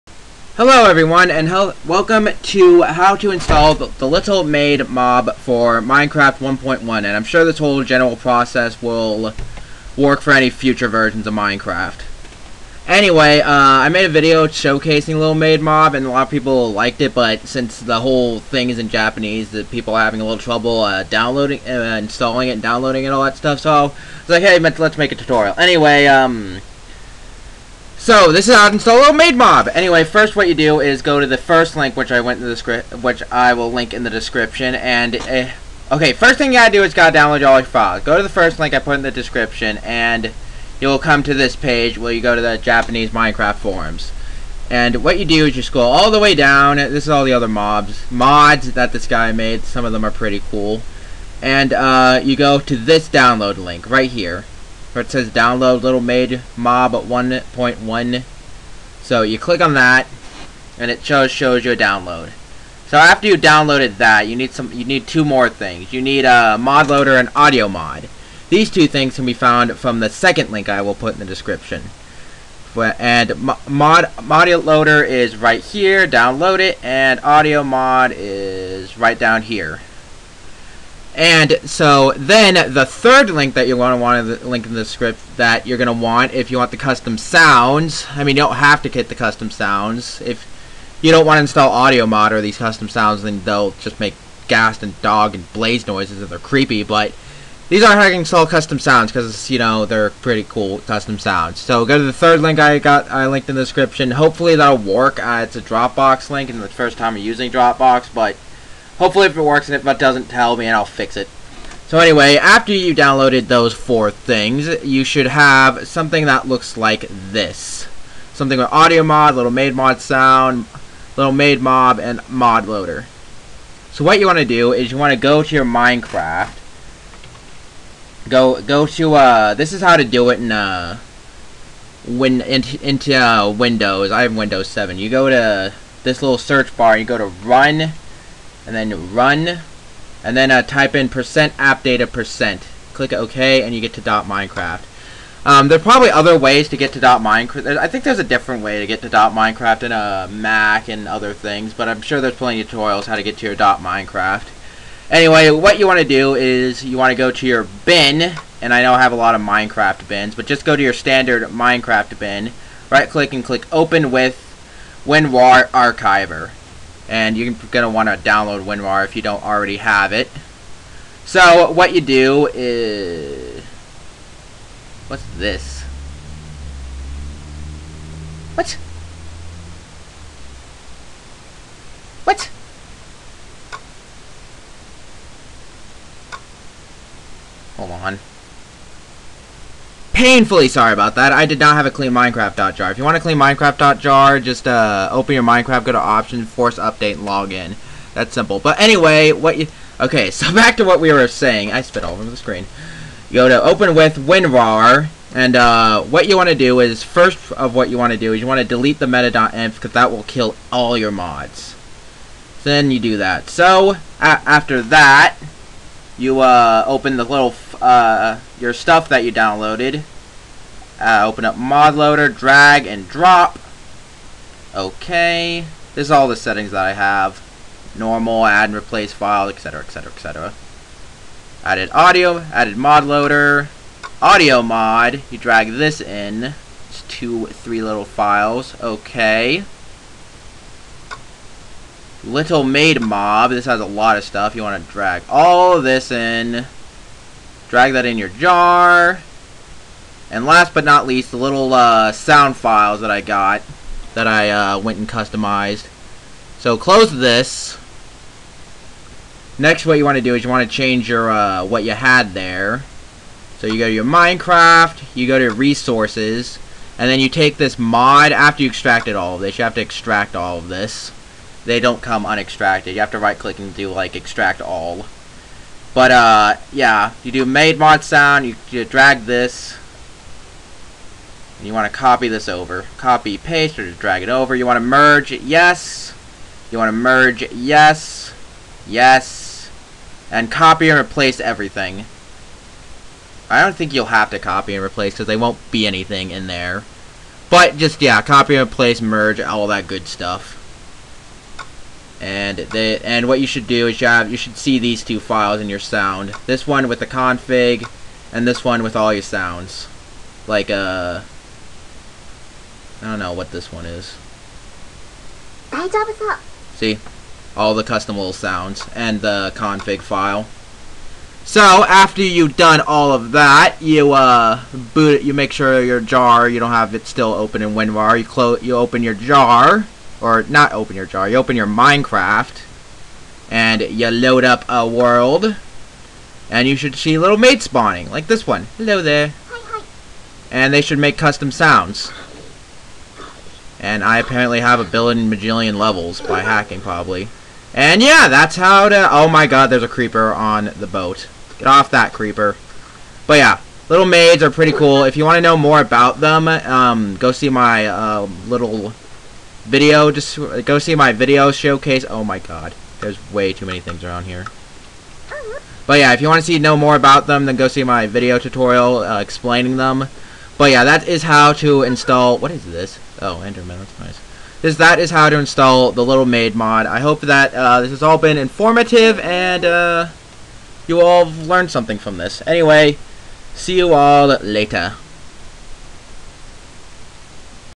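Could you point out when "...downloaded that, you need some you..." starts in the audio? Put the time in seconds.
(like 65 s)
63 s.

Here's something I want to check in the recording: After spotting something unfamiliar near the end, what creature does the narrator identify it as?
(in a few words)
Enderman.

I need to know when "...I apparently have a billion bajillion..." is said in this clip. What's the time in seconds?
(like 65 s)
344 s.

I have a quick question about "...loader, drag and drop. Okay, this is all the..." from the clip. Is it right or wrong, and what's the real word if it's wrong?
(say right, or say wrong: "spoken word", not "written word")
right.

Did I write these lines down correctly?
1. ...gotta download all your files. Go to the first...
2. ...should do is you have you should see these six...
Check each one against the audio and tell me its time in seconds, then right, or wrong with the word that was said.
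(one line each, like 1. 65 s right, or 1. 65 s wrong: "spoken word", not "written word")
1. 36 s right
2. 303 s wrong: "two", not "six".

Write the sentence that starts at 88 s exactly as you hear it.
I mean, you don't have to get the custom sounds.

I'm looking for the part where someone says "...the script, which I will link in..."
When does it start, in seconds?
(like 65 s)
32 s.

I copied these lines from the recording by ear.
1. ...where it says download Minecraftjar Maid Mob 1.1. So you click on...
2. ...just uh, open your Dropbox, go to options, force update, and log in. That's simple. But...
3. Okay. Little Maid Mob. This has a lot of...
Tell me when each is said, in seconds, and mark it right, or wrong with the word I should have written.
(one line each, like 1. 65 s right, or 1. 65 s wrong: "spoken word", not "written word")
1. 54 s wrong: "Little", not "Minecraftjar"
2. 194 s wrong: "Minecraft", not "Dropbox"
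3. 238 s right.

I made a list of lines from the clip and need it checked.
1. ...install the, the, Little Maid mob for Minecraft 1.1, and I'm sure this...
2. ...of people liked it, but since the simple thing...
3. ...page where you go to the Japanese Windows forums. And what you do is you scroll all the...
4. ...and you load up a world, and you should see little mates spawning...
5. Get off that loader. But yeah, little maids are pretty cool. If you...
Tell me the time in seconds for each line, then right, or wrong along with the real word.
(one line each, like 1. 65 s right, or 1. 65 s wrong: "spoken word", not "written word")
1. 3 s right
2. 16 s wrong: "whole", not "simple"
3. 41 s wrong: "Minecraft", not "Windows"
4. 333 s right
5. 351 s wrong: "creeper", not "loader".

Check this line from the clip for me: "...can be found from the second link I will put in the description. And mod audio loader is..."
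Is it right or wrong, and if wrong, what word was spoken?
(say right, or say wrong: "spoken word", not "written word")
right.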